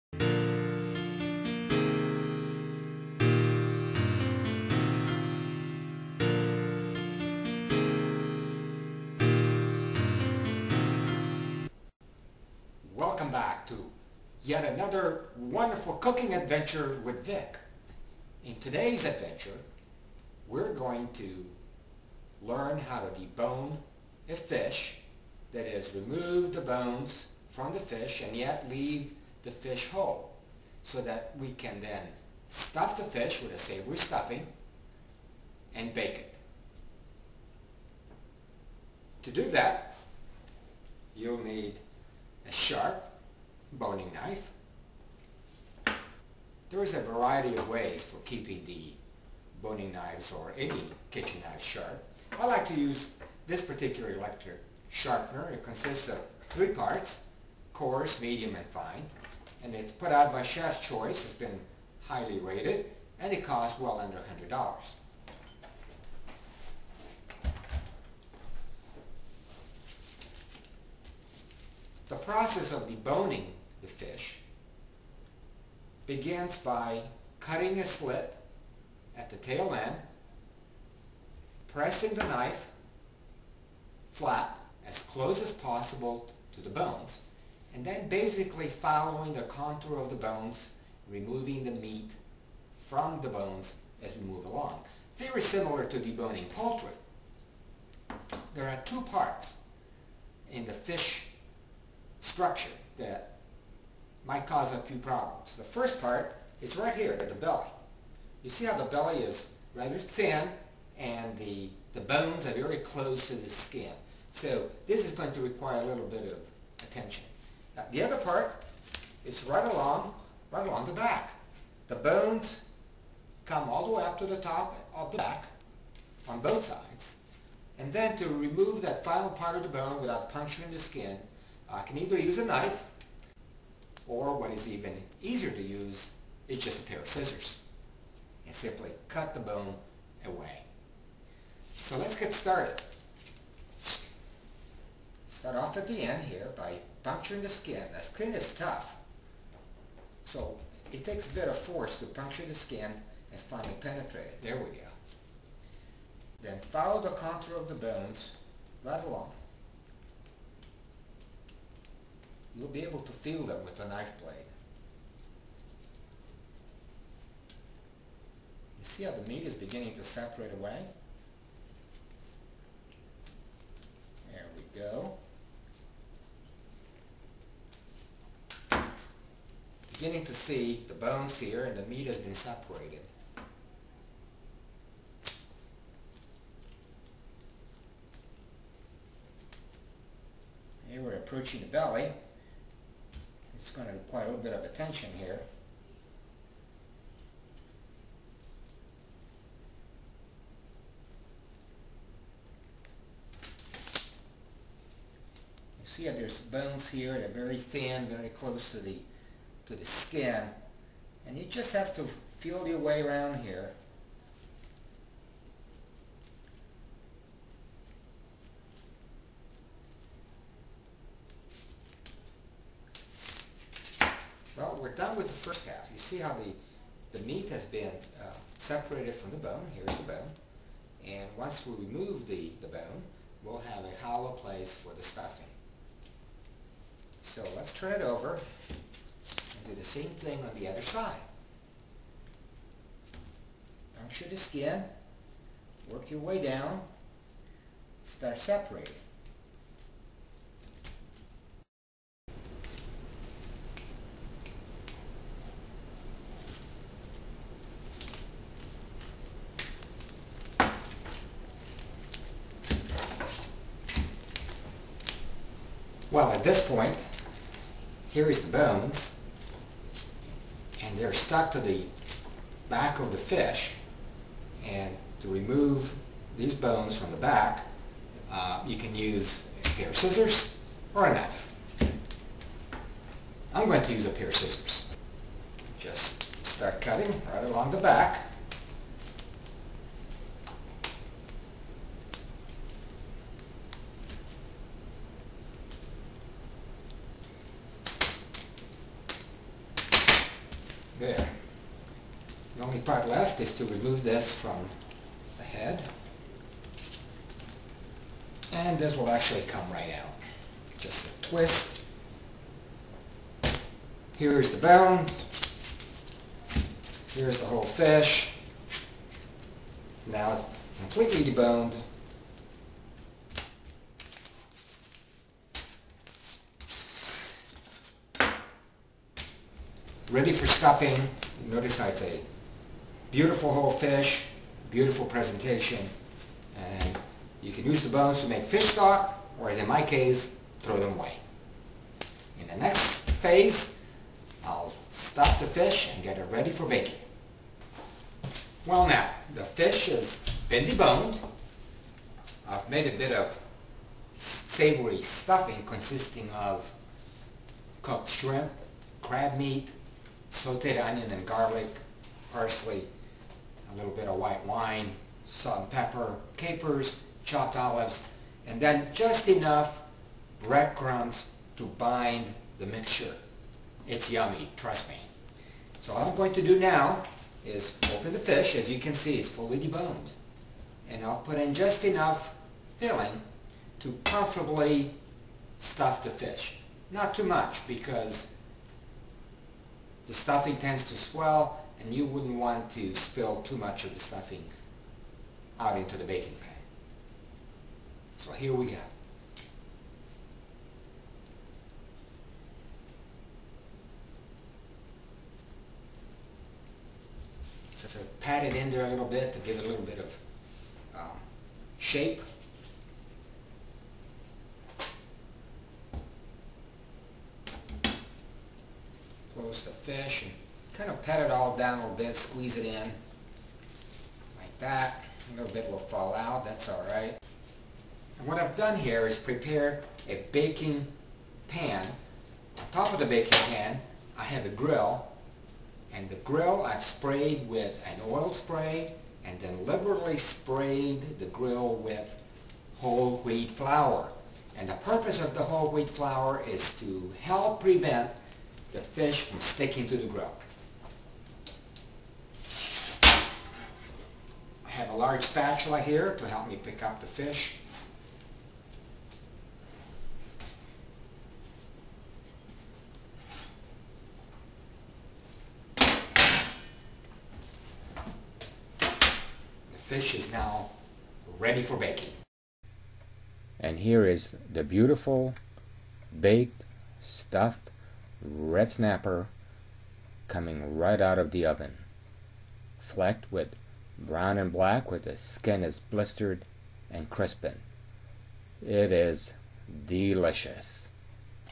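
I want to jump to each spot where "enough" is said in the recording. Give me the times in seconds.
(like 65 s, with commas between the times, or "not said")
369 s, 381 s.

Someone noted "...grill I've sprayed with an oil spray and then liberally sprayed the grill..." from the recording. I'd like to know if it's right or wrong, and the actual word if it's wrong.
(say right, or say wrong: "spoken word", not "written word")
right.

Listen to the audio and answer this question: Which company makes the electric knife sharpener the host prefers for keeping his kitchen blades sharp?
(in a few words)
Chef's Choice.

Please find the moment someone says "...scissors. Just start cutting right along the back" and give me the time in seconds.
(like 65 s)
284 s.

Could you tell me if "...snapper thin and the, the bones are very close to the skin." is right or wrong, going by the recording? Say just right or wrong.
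wrong.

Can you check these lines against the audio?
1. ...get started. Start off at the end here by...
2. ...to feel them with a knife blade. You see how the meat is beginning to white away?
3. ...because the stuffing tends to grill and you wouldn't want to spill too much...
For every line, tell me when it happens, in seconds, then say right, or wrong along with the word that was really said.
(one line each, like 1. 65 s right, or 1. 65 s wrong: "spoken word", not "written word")
1. 142 s right
2. 162 s wrong: "separate", not "white"
3. 387 s wrong: "swell", not "grill".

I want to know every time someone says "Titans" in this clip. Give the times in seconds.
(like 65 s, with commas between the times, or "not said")
not said.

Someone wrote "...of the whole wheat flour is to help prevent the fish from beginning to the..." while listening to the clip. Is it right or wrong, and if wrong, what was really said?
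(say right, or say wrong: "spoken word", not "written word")
wrong: "sticking", not "beginning".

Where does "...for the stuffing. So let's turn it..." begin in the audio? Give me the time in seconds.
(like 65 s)
234 s.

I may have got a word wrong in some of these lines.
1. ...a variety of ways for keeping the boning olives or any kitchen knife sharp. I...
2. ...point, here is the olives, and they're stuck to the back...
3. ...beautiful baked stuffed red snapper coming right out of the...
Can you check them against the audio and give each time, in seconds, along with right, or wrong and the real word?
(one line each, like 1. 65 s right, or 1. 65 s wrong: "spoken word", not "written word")
1. 46 s wrong: "knives", not "olives"
2. 266 s wrong: "bones", not "olives"
3. 474 s right.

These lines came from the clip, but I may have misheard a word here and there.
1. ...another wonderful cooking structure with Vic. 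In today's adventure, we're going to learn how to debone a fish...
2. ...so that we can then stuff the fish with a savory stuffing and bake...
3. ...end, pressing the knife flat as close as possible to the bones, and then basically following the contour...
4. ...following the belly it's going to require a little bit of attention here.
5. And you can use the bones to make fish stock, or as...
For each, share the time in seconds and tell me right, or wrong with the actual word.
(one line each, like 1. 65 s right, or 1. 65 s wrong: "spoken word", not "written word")
1. 14 s wrong: "adventure", not "structure"
2. 30 s right
3. 79 s right
4. 191 s wrong: "approaching", not "following"
5. 336 s right.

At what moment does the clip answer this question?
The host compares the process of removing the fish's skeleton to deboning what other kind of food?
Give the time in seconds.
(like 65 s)
96 s.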